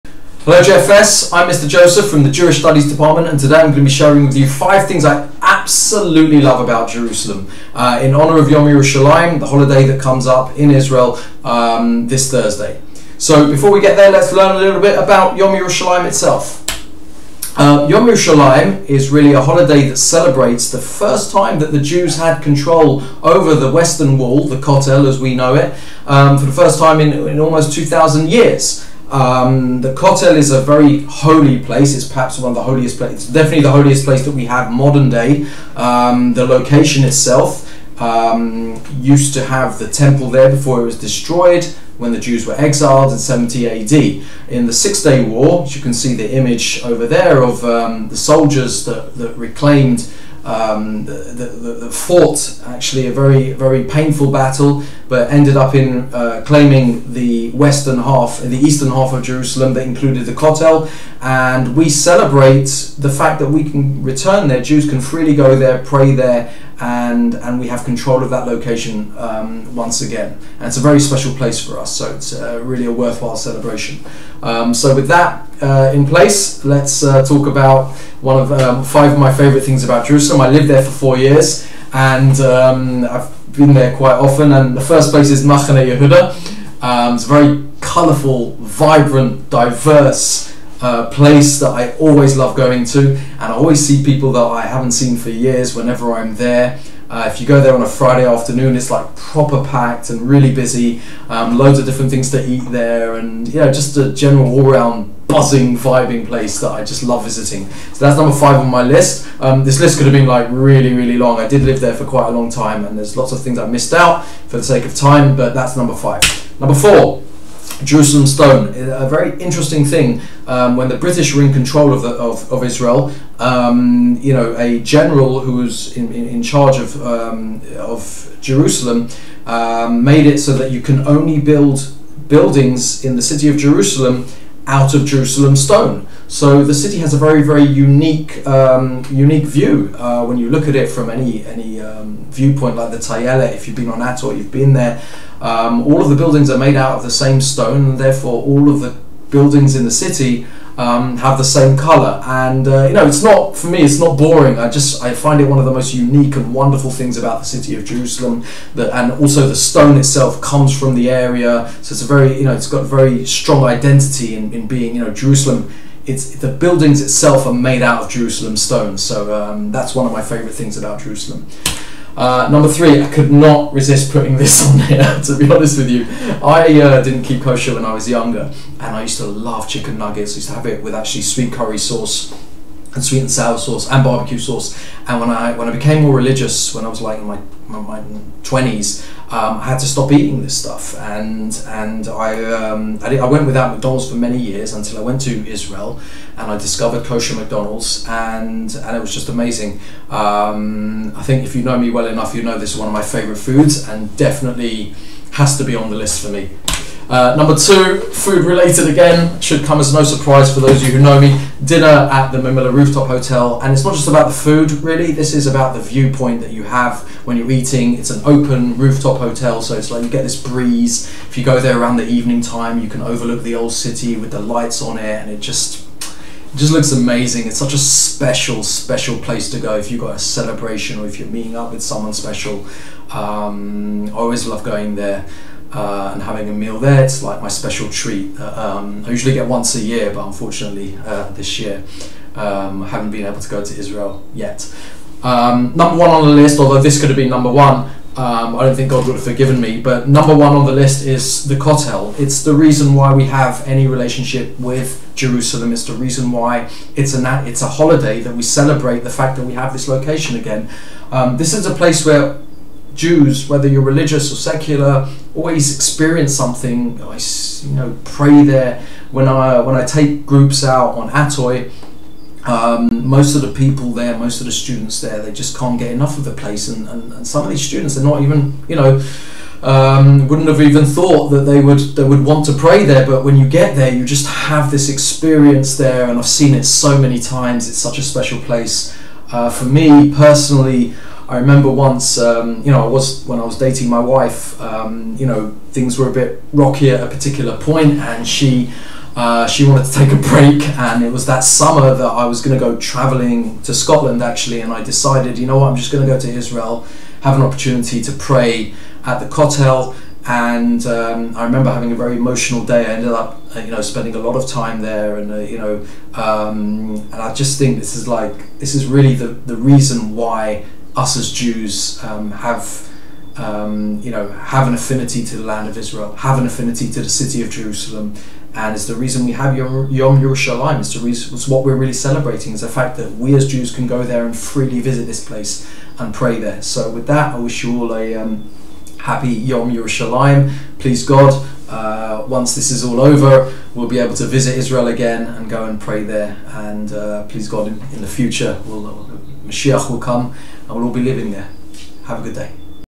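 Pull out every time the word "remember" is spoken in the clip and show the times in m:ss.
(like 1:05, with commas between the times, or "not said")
4:51, 5:11.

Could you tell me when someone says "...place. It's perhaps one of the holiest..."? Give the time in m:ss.
0:31.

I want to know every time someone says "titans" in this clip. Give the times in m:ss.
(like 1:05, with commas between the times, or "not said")
not said.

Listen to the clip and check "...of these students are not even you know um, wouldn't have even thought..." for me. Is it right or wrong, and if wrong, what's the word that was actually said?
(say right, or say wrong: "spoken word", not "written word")
right.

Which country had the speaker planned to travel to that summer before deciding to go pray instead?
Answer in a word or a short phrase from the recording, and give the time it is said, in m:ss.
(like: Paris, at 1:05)
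Scotland, at 5:03.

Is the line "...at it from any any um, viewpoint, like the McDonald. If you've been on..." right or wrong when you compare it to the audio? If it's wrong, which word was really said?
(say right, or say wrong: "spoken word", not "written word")
wrong: "Tayelet", not "McDonald".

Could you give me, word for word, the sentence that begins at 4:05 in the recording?
Um, number one on the list, although this could have been number one, um, I don't think God would have forgiven me.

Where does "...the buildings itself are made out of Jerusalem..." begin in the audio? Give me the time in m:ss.
2:46.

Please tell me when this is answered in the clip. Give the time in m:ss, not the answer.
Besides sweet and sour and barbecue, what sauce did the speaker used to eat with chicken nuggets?
3:01.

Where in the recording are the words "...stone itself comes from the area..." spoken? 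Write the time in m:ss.
2:39.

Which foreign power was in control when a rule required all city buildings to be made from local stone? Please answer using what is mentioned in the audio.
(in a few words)
The British.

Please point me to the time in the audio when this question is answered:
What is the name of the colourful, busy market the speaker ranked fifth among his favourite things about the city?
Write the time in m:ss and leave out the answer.
1:25.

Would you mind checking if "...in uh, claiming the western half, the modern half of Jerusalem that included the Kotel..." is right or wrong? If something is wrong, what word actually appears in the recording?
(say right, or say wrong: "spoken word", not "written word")
wrong: "eastern", not "modern".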